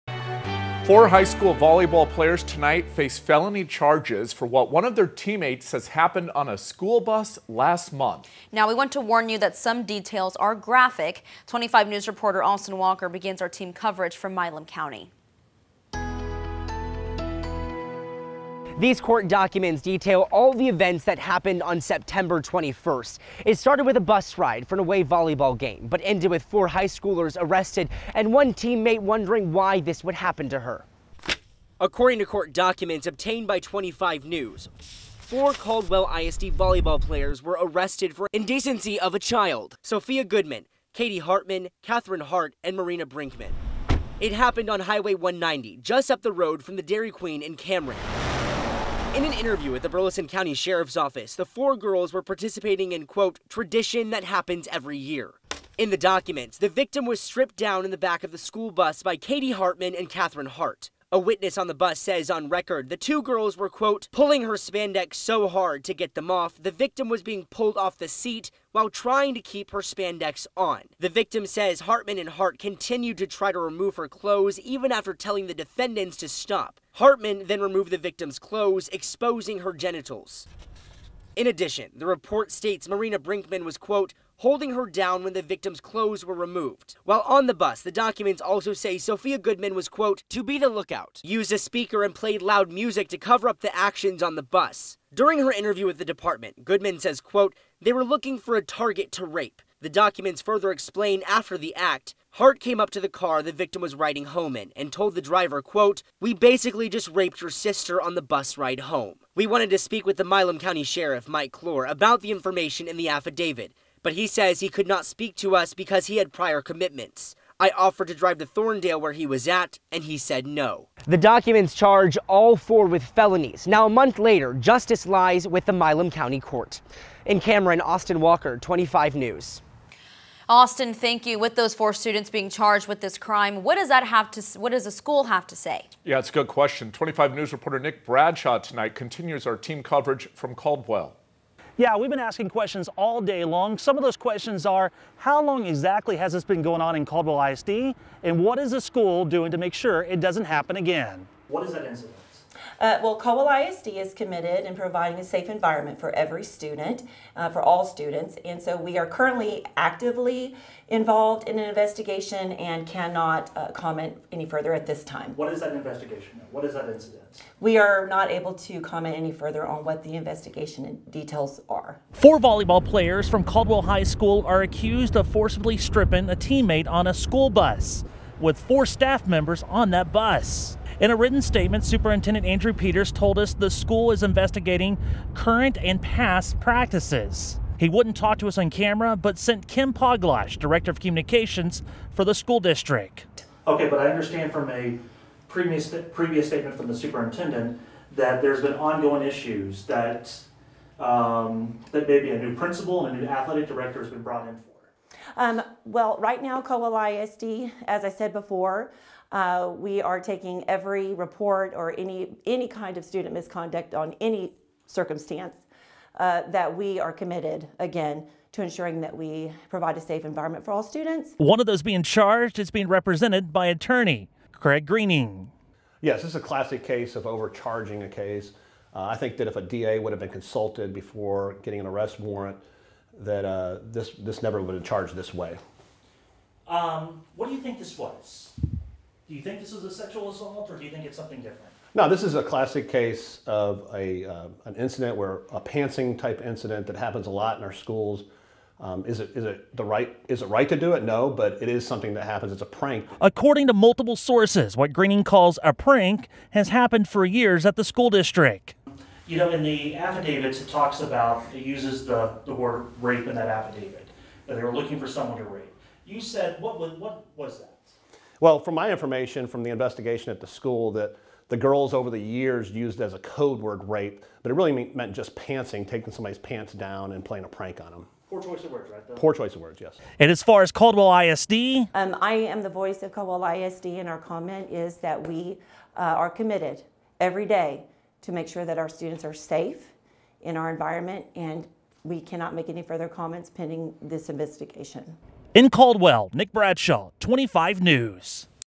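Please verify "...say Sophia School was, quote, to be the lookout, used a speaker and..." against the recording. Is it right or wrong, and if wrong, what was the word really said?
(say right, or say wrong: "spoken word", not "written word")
wrong: "Goodman", not "School".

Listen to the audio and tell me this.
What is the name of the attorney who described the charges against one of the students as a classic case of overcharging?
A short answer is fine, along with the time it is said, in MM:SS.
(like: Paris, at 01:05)
Craig Greening, at 03:44.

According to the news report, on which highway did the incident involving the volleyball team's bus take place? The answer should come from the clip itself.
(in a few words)
Highway 190.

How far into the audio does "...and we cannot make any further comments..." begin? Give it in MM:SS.
04:51.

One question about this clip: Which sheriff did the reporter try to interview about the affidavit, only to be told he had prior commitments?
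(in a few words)
Mike Clore.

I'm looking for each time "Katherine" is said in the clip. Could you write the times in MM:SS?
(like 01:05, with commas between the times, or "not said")
00:41, 01:00.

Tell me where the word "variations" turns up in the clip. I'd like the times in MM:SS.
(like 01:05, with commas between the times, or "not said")
not said.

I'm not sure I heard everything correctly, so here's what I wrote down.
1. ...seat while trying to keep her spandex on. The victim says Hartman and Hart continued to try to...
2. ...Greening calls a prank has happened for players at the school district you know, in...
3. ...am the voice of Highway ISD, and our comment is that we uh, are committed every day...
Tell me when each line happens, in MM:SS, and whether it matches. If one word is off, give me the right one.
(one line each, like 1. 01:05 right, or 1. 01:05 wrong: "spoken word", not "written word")
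1. 01:08 right
2. 04:14 wrong: "years", not "players"
3. 04:42 wrong: "Caldwell", not "Highway".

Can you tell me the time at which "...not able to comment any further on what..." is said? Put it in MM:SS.
02:48.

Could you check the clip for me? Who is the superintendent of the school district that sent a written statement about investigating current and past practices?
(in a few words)
Andrew Peters.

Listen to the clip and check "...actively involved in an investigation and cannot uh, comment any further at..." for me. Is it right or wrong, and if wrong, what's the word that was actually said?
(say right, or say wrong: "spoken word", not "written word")
right.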